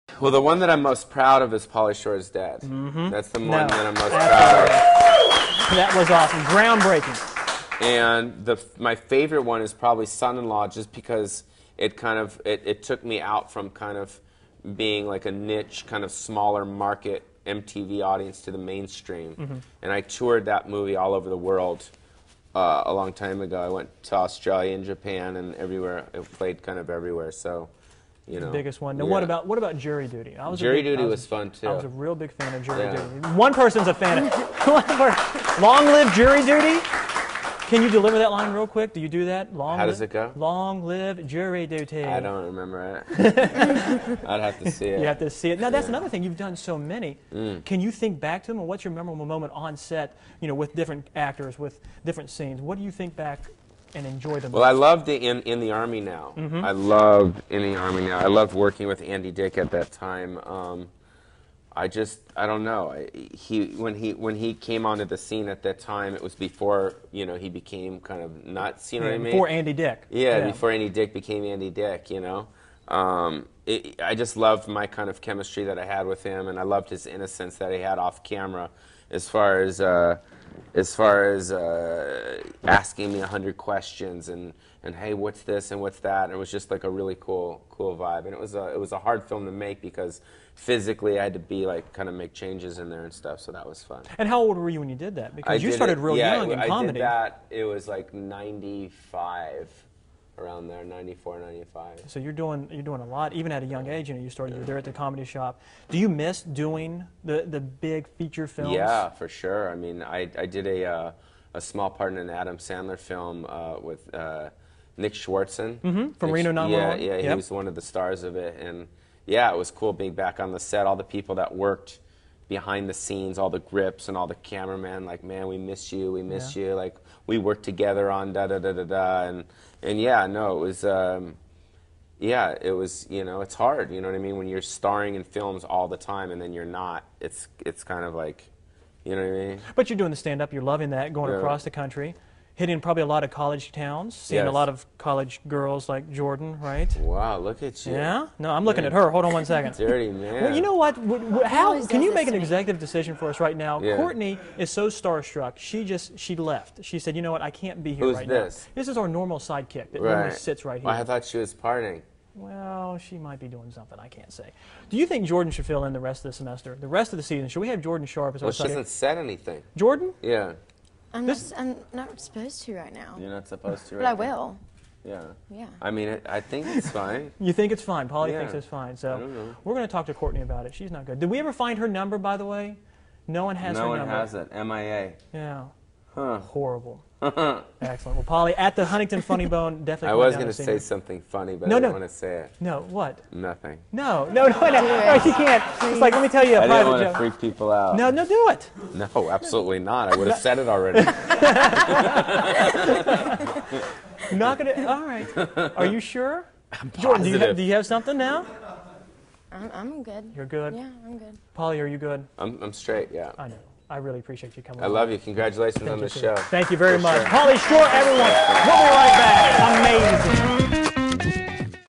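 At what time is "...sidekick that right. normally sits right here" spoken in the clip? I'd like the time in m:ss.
2:39.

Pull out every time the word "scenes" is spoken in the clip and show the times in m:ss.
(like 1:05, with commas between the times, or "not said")
0:52, 1:05, 2:02.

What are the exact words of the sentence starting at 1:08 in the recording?
you know yeah, what I mean before Andy Dick.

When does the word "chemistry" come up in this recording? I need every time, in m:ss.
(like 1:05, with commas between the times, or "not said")
1:15.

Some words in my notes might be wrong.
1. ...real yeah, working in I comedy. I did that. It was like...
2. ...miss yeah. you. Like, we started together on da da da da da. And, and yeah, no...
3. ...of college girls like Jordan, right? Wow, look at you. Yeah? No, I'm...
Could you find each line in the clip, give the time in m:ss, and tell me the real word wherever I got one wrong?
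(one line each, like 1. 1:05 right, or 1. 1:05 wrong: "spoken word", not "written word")
1. 1:36 wrong: "young", not "working"
2. 2:06 wrong: "worked", not "started"
3. 2:24 right.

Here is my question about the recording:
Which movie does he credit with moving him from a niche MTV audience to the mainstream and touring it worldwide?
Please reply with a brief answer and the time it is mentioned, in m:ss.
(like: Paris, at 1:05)
Son-in-Law, at 0:10.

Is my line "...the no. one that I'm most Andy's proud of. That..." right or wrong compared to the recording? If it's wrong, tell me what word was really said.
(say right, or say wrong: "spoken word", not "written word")
wrong: "That", not "Andy".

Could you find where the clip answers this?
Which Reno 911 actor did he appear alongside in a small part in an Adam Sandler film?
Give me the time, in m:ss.
1:54.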